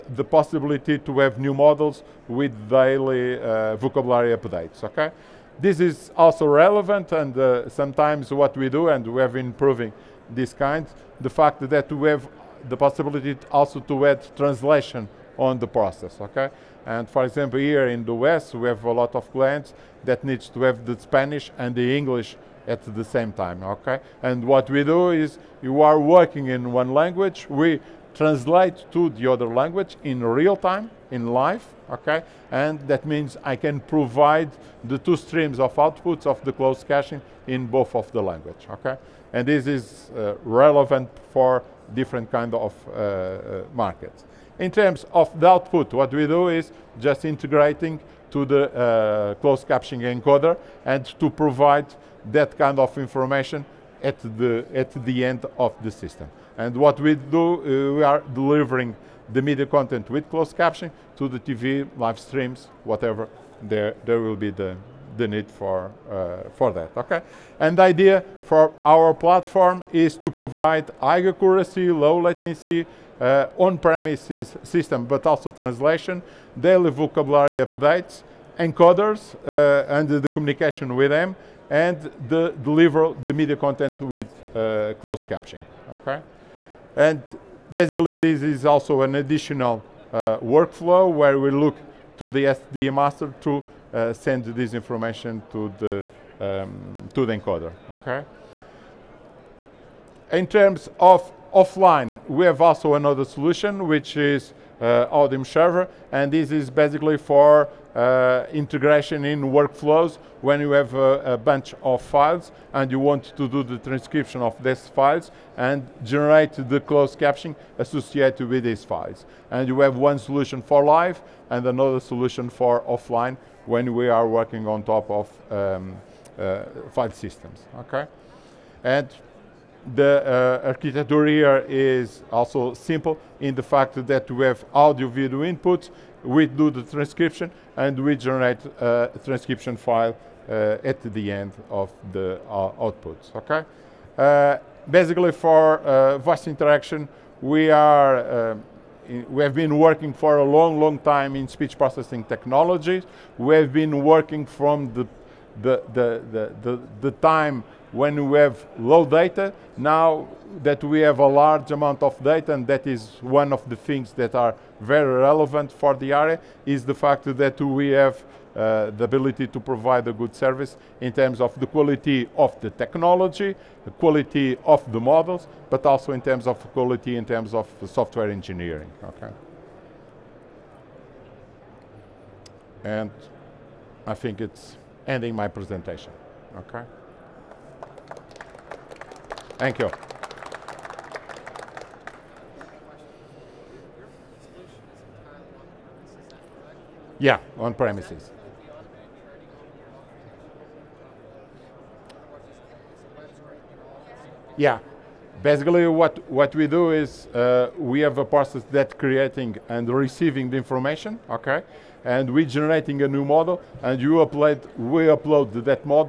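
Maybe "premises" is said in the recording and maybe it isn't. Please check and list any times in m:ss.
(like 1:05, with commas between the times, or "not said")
1:13, 3:17.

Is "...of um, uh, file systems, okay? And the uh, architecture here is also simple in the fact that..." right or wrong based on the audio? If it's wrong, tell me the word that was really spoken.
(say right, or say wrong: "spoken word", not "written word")
right.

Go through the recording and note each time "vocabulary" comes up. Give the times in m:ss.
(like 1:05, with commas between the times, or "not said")
0:03, 1:16.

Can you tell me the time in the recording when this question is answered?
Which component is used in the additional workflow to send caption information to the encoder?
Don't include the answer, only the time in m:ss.
1:32.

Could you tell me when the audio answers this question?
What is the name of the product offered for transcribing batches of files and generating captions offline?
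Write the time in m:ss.
1:45.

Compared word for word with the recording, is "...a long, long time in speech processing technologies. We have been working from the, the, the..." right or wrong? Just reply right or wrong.
right.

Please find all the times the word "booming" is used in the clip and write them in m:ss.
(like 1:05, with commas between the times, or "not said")
not said.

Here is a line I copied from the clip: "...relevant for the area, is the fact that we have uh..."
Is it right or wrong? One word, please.
right.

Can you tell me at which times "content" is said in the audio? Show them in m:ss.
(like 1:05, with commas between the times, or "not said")
0:59, 1:23.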